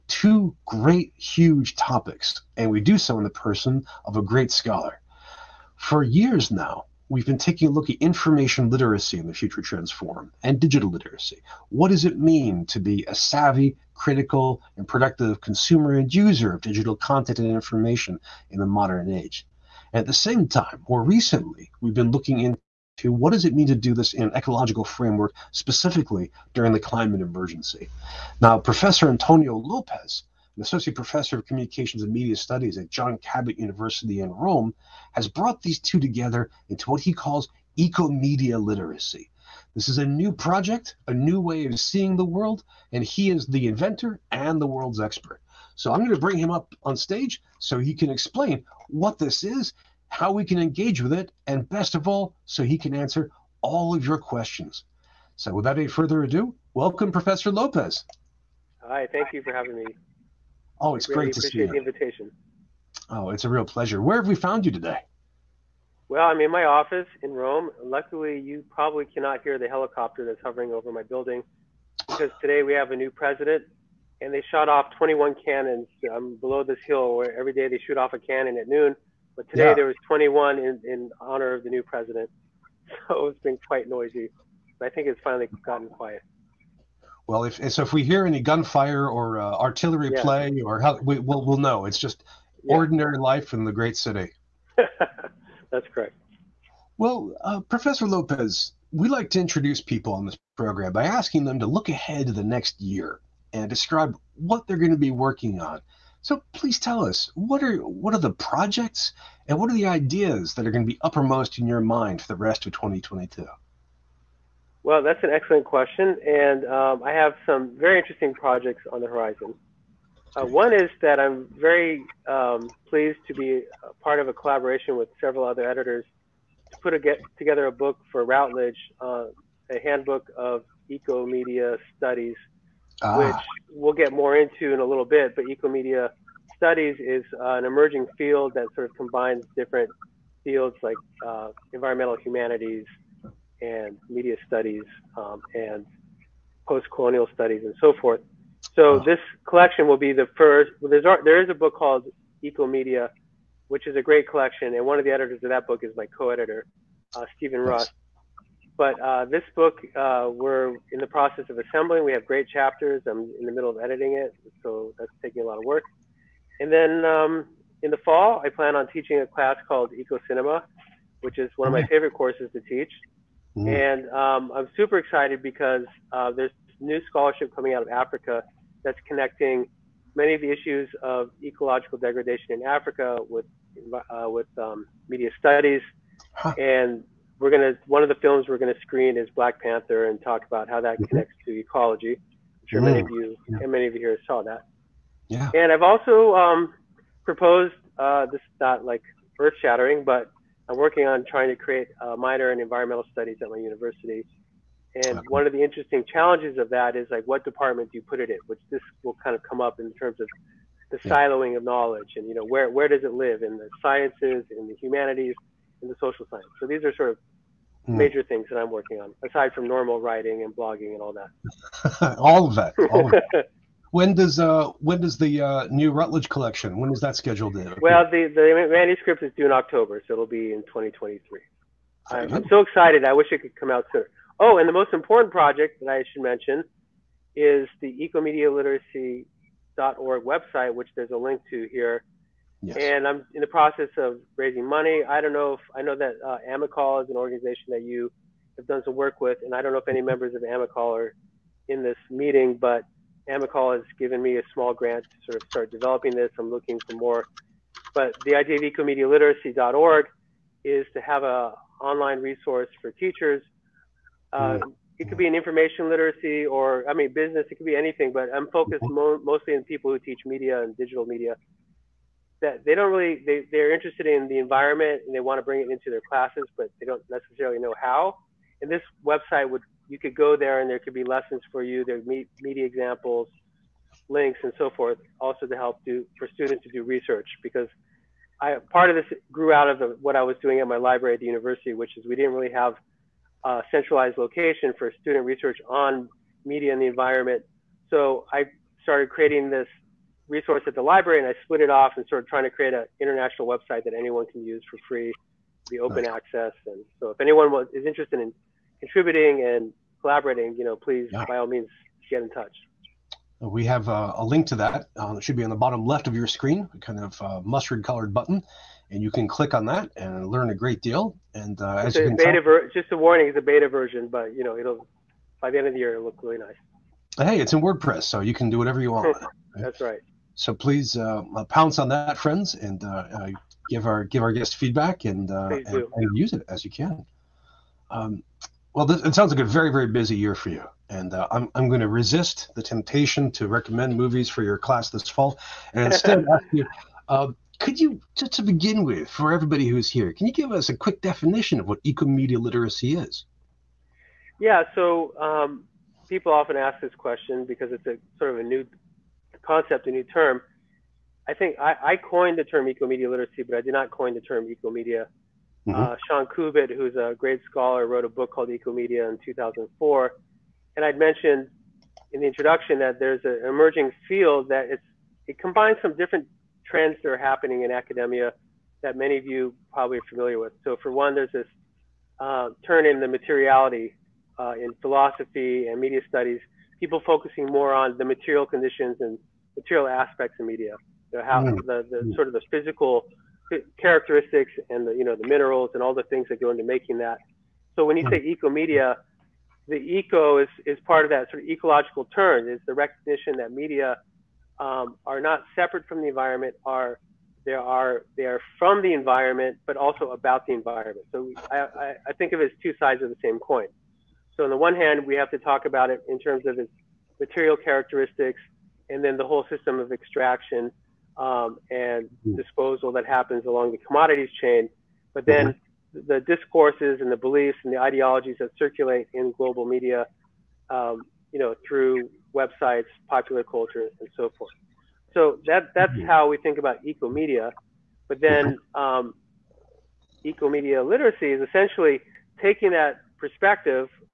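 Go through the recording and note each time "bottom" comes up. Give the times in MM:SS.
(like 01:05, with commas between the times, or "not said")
05:15.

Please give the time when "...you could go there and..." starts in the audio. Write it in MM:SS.
04:39.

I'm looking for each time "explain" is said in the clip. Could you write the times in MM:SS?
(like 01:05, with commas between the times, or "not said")
00:48.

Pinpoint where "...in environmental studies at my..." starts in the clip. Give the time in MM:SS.
03:22.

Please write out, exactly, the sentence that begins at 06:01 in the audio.
I think I, I coined the term eco media literacy, but I did not coin the term eco media uh, mm-hmm.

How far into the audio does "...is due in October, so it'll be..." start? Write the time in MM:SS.
03:49.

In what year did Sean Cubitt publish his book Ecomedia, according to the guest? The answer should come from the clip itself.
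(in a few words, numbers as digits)
2004.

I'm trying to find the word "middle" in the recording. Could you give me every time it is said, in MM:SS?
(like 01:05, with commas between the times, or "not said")
02:43.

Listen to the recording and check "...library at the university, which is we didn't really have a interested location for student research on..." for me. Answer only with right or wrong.
wrong.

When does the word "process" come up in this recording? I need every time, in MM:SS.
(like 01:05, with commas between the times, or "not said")
02:41, 04:03.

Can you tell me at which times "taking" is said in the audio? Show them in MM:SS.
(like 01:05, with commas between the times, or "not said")
00:07, 02:45, 07:22.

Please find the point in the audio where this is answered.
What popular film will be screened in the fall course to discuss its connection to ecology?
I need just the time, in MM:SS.
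03:09.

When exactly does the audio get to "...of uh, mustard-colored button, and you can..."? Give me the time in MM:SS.
05:17.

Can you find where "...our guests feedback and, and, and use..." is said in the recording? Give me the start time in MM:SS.
05:34.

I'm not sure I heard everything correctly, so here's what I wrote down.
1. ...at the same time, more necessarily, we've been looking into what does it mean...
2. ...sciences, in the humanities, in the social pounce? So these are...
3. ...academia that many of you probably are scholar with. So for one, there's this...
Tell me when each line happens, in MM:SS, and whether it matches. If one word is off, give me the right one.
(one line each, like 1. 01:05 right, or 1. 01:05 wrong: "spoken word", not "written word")
1. 00:20 wrong: "recently", not "necessarily"
2. 03:33 wrong: "science", not "pounce"
3. 06:17 wrong: "familiar", not "scholar".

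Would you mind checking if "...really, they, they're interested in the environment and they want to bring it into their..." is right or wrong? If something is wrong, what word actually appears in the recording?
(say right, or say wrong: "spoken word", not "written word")
right.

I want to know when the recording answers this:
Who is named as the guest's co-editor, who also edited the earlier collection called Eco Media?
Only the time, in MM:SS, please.
02:37.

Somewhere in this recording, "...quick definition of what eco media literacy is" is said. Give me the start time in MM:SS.
05:50.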